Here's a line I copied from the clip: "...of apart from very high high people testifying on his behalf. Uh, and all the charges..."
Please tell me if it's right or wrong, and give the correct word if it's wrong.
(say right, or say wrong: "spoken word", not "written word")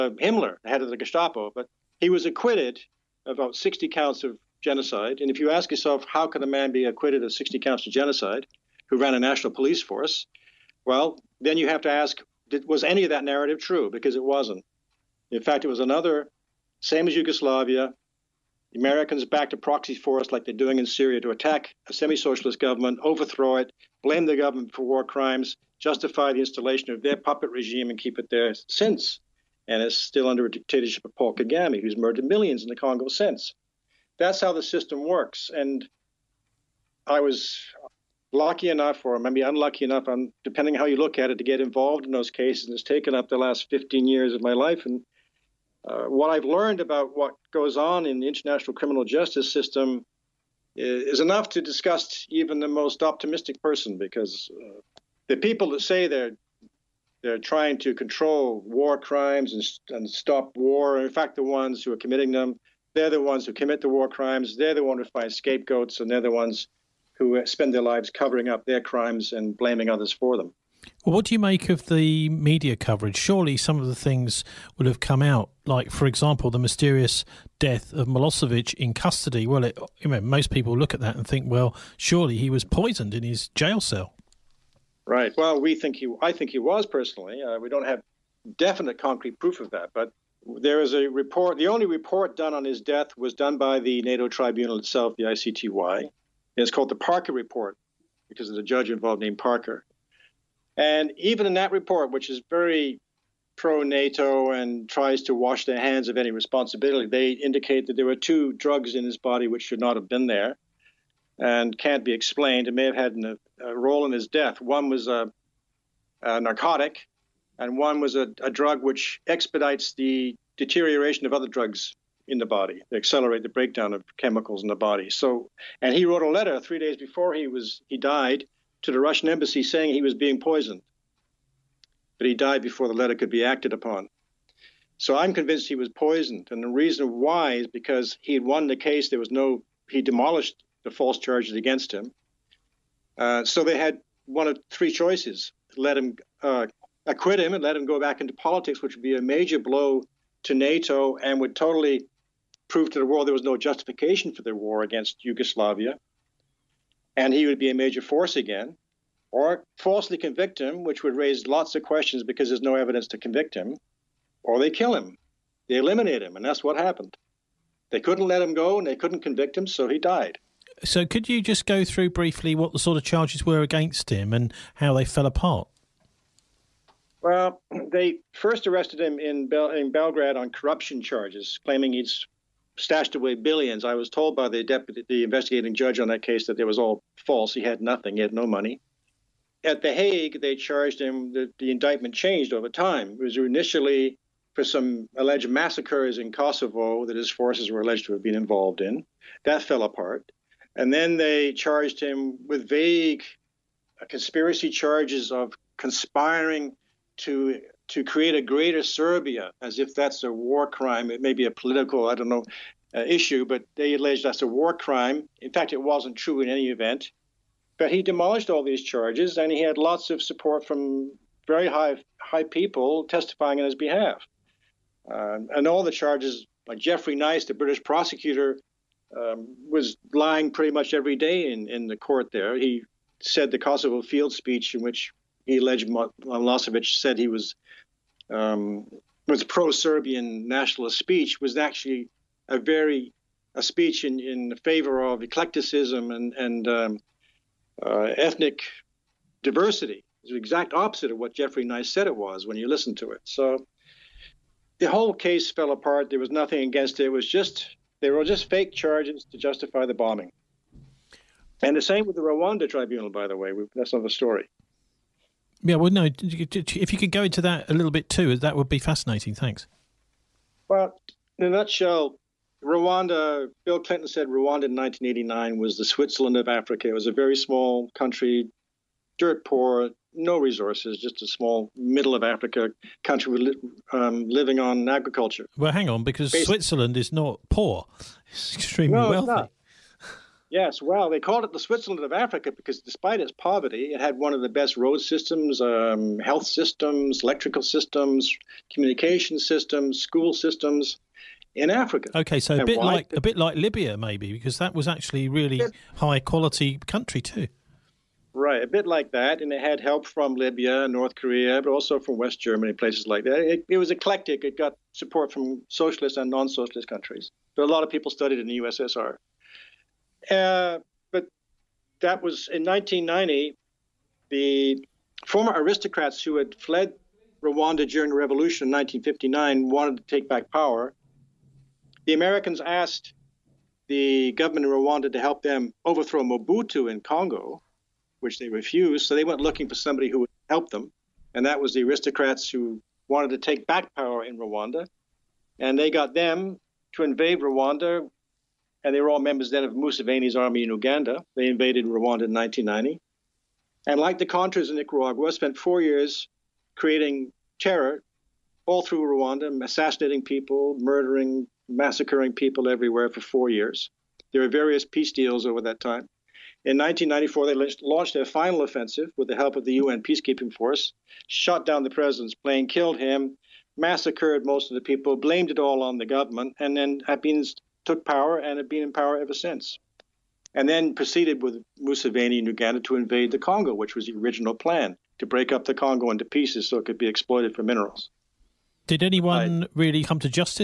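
wrong: "support", not "apart".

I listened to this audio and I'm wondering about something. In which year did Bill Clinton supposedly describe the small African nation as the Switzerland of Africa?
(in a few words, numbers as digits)
1989.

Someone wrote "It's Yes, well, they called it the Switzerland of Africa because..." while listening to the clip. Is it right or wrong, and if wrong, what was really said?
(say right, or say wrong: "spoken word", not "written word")
right.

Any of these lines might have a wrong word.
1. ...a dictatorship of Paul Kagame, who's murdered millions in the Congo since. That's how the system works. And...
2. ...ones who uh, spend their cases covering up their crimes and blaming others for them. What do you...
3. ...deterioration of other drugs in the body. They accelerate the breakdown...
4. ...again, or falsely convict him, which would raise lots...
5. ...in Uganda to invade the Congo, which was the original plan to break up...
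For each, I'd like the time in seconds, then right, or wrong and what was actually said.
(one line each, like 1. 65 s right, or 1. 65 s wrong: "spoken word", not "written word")
1. 30 s right
2. 66 s wrong: "lives", not "cases"
3. 120 s right
4. 158 s right
5. 382 s right.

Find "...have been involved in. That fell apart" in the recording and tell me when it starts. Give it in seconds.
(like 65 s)
198 s.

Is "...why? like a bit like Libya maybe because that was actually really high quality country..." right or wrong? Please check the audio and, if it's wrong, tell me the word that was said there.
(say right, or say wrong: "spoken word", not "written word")
right.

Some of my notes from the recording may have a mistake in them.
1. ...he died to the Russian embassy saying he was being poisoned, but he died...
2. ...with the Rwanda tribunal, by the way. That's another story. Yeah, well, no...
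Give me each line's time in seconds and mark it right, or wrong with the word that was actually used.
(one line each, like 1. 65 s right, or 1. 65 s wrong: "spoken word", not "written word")
1. 127 s right
2. 262 s right.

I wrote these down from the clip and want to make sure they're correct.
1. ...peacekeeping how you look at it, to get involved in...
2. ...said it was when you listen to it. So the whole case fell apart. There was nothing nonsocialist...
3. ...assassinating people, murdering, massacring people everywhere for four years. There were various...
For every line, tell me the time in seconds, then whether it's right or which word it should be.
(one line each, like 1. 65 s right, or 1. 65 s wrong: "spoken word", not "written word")
1. 40 s wrong: "depending", not "peacekeeping"
2. 251 s wrong: "against", not "nonsocialist"
3. 359 s right.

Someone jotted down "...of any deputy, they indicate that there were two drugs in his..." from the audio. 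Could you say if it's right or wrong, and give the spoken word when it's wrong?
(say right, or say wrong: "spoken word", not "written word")
wrong: "responsibility", not "deputy".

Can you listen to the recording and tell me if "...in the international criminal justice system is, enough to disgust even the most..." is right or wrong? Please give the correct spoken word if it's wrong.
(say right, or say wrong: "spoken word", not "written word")
right.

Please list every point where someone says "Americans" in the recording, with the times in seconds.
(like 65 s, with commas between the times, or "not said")
18 s, 332 s.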